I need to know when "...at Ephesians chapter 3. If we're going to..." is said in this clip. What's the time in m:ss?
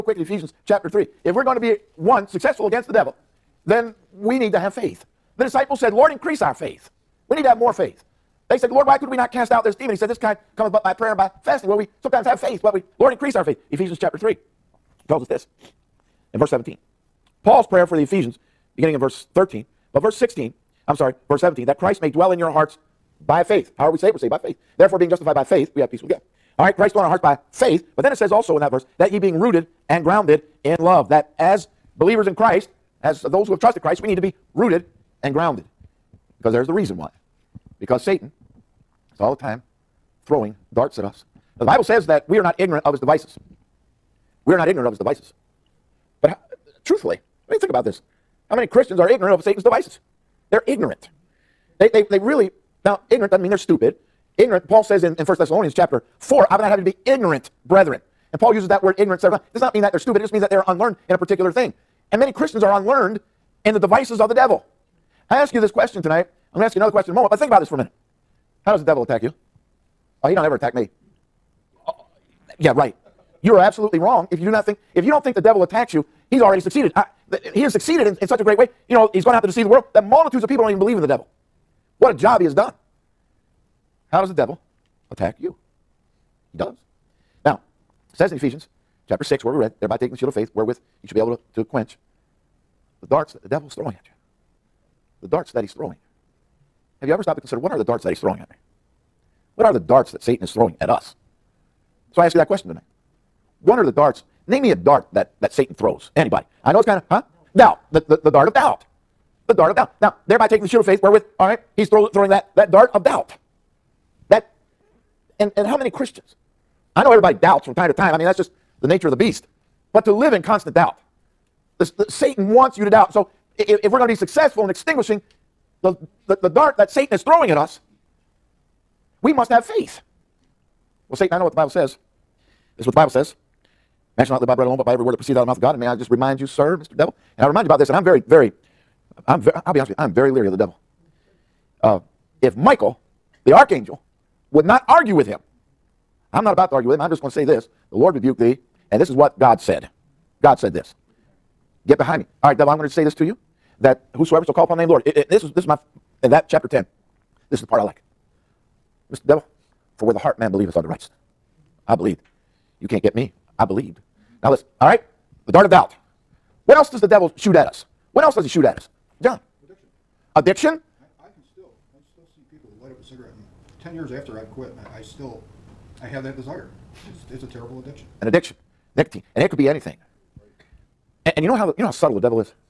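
0:00.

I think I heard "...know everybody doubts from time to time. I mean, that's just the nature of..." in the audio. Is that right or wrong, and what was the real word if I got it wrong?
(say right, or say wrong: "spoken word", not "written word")
right.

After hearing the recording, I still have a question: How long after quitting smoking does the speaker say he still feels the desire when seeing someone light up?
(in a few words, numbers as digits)
10 years.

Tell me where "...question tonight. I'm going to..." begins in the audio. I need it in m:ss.
1:05.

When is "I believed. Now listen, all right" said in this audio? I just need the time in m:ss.
2:43.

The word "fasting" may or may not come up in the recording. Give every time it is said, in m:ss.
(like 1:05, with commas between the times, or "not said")
0:11.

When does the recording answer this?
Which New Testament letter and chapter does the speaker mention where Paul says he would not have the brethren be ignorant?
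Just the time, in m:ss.
0:55.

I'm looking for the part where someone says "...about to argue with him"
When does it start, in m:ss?
2:26.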